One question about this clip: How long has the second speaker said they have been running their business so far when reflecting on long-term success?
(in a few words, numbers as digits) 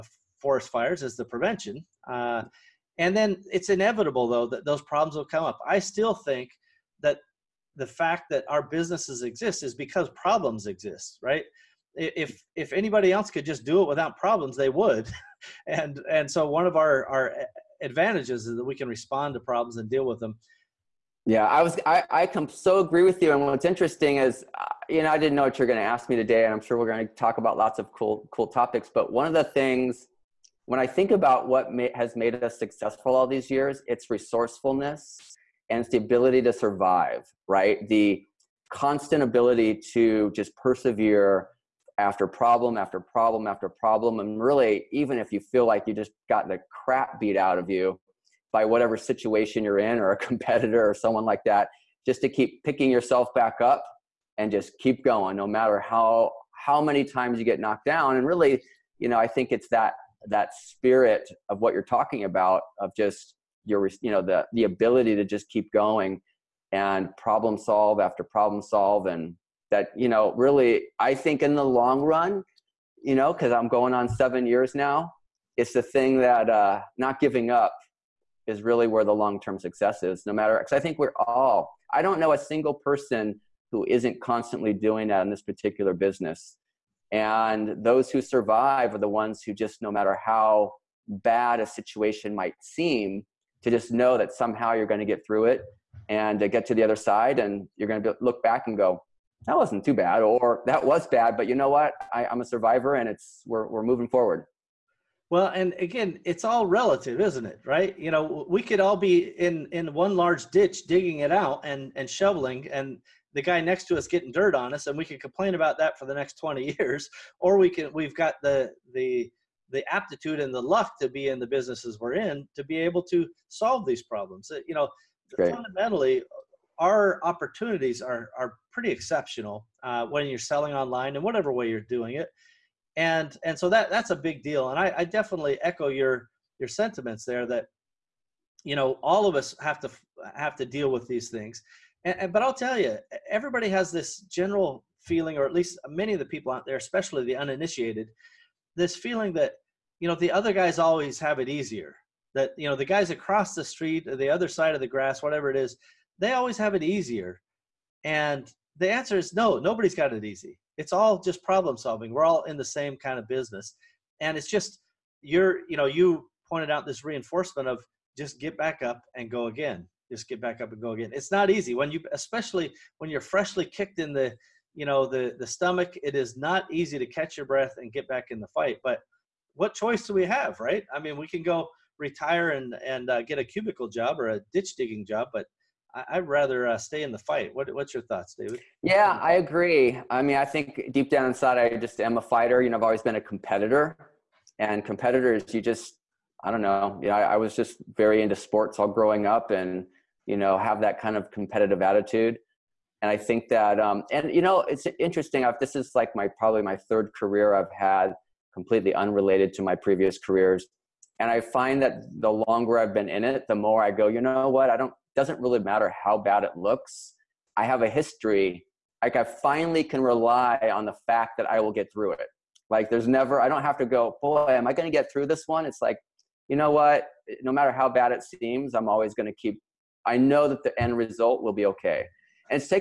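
7 years.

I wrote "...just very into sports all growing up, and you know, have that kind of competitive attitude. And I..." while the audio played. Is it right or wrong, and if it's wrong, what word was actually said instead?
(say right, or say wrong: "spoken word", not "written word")
right.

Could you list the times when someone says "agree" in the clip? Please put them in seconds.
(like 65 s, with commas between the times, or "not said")
22 s, 189 s.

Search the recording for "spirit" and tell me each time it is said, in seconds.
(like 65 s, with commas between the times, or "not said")
60 s.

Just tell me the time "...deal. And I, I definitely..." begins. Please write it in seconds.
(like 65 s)
134 s.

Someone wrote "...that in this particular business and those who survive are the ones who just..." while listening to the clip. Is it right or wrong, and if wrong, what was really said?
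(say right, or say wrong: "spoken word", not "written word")
right.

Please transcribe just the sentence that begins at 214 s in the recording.
I don't doesn't really matter how bad it looks.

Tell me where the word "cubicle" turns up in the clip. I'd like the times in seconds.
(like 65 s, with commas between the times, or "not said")
183 s.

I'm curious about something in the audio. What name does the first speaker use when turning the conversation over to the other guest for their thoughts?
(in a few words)
David.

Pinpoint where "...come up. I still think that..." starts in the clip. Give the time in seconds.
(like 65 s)
5 s.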